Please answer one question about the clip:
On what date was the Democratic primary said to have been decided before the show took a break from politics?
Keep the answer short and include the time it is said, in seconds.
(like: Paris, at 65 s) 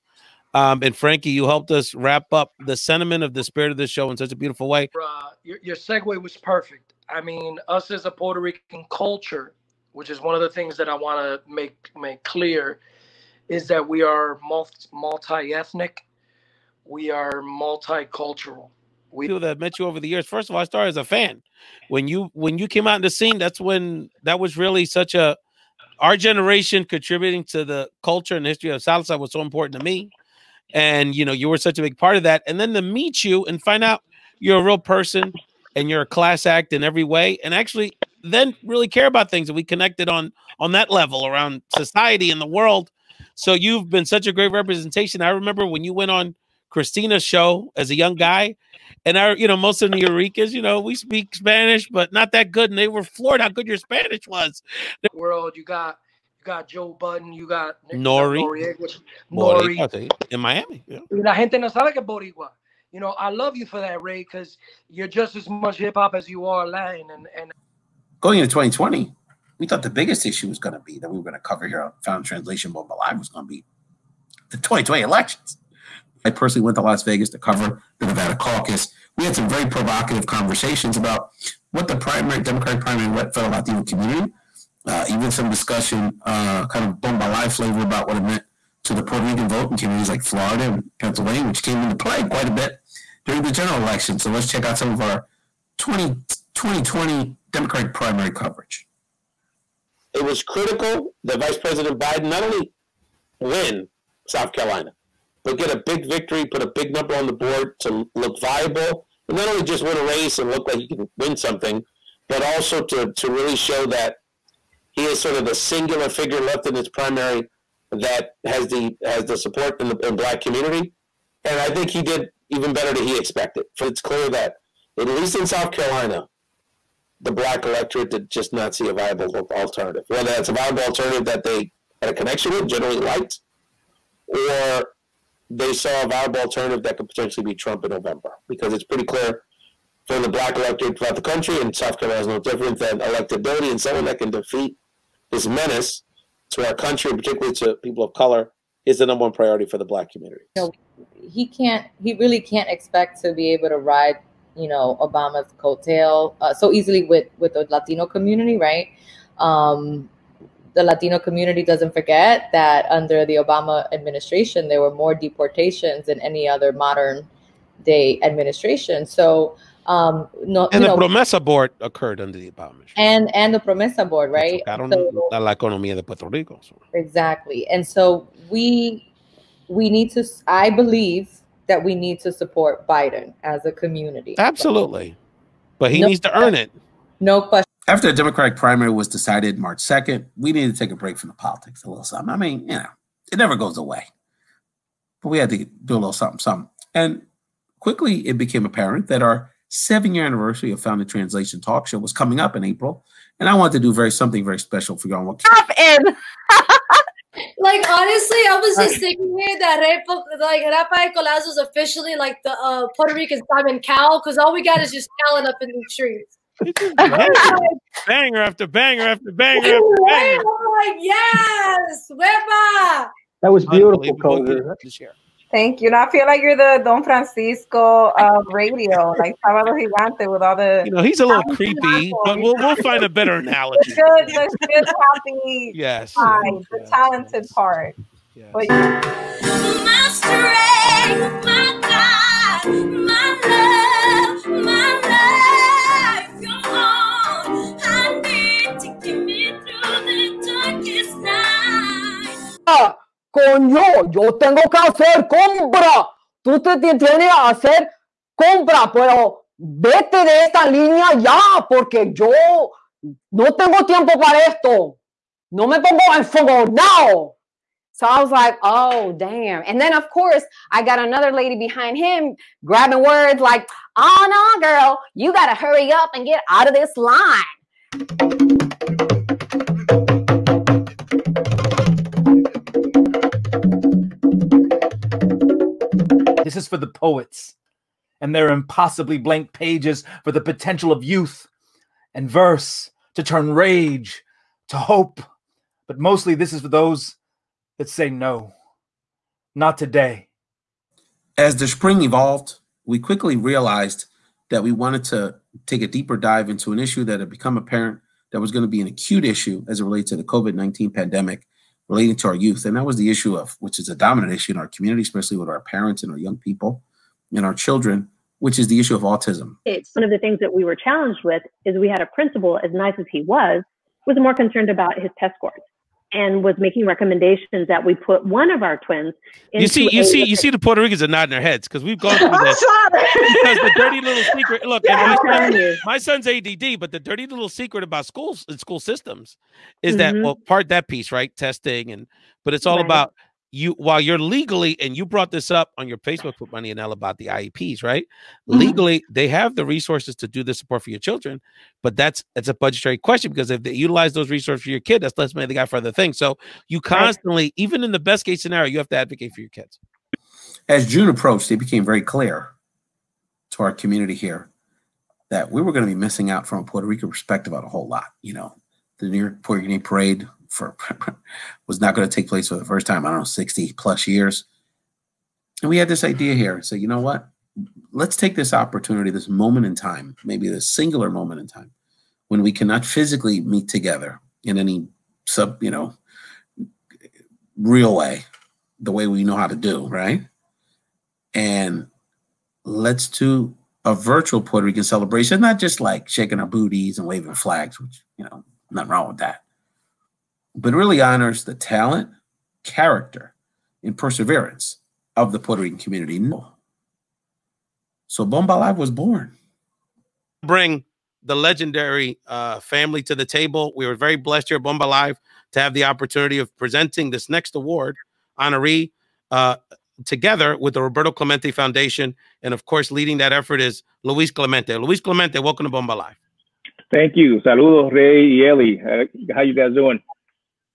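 March 2, at 189 s.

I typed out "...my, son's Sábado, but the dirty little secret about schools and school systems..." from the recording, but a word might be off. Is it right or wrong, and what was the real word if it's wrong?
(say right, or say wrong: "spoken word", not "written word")
wrong: "ADD", not "Sábado".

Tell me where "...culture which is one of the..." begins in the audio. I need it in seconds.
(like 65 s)
8 s.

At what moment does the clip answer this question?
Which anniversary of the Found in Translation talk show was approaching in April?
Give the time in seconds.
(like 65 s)
199 s.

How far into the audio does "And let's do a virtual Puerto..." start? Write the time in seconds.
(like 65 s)
391 s.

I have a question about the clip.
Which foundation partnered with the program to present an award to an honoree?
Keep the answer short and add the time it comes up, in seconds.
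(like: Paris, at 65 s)
Roberto Clemente Foundation, at 420 s.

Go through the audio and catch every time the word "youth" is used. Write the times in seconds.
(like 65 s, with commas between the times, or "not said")
291 s, 312 s.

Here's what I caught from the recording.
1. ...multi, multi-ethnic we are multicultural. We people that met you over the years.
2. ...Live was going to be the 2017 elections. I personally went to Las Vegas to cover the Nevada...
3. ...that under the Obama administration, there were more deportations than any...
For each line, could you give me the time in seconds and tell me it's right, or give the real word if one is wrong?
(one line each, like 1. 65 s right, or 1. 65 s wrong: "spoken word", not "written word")
1. 14 s right
2. 72 s wrong: "2020", not "2017"
3. 162 s right.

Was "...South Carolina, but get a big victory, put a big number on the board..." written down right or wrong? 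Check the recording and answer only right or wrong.
right.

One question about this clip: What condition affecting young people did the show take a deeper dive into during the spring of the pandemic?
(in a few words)
autism.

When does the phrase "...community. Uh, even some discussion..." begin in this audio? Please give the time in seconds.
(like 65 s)
83 s.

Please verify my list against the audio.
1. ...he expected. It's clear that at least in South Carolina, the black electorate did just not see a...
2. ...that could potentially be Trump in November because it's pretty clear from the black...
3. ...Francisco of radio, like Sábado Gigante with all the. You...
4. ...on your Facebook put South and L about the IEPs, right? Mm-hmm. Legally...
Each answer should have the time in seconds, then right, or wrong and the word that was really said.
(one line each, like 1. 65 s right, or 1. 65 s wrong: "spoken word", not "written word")
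1. 123 s right
2. 136 s right
3. 227 s right
4. 345 s wrong: "Money", not "South".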